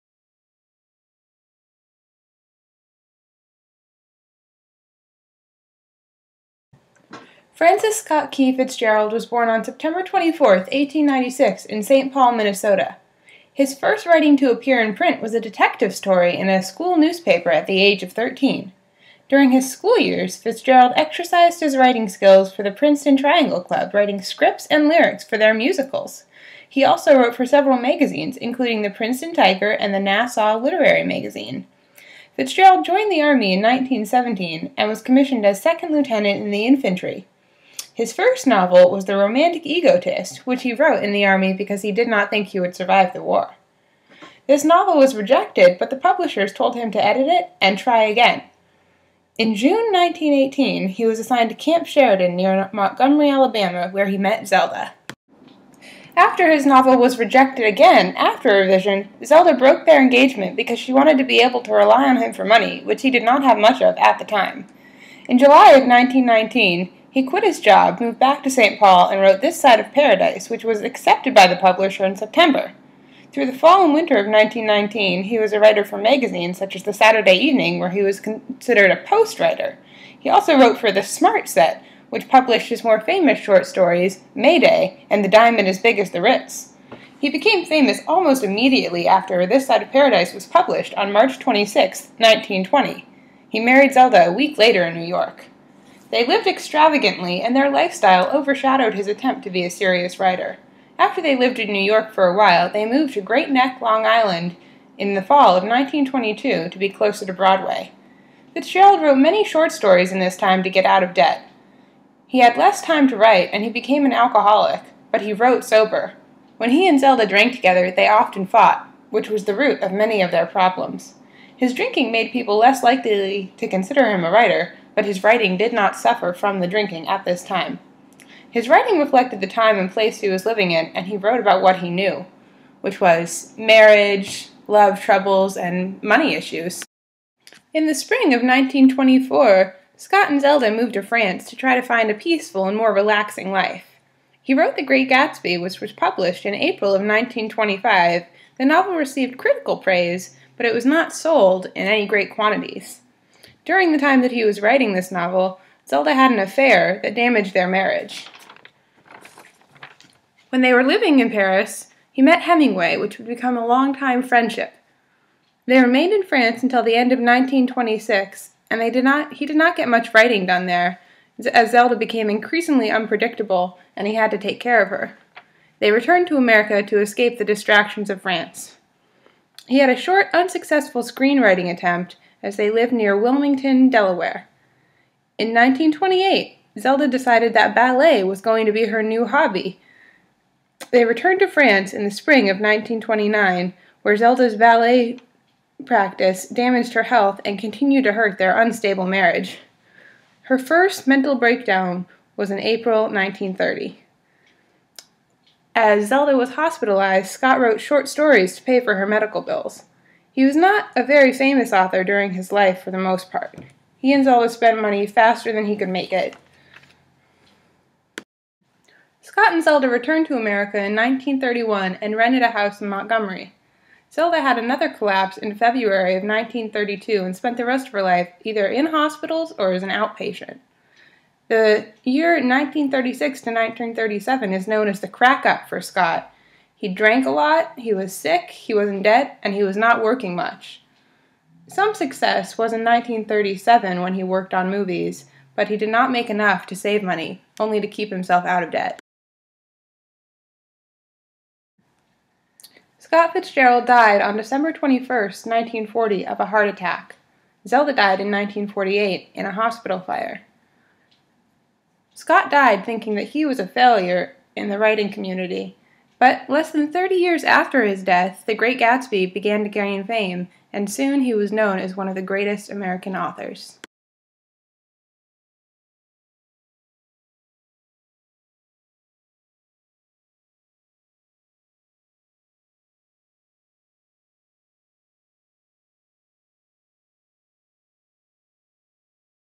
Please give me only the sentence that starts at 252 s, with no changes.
Scott Fitzgerald died on December 21, 1940, of a heart attack.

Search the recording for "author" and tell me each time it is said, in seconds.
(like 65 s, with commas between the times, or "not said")
211 s, 273 s.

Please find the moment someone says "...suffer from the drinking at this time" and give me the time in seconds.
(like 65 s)
125 s.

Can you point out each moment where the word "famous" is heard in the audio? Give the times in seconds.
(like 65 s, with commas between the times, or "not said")
83 s, 87 s, 211 s.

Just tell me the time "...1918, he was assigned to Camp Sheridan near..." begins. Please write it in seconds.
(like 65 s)
49 s.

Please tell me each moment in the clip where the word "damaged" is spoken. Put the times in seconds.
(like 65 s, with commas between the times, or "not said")
157 s, 196 s.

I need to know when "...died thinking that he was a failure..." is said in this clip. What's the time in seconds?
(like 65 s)
262 s.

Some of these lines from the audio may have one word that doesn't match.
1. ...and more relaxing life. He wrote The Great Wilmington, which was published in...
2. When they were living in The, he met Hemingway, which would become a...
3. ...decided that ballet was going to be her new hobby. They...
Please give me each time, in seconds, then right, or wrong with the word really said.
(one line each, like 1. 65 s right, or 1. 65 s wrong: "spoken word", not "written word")
1. 142 s wrong: "Gatsby", not "Wilmington"
2. 160 s wrong: "Paris", not "The"
3. 187 s right.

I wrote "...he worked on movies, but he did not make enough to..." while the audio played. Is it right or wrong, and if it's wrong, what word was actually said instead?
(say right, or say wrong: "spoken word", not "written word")
right.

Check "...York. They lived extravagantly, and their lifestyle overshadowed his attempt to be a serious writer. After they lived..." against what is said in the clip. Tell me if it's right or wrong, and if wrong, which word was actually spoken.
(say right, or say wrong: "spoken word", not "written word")
right.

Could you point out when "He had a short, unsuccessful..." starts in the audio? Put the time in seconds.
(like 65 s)
179 s.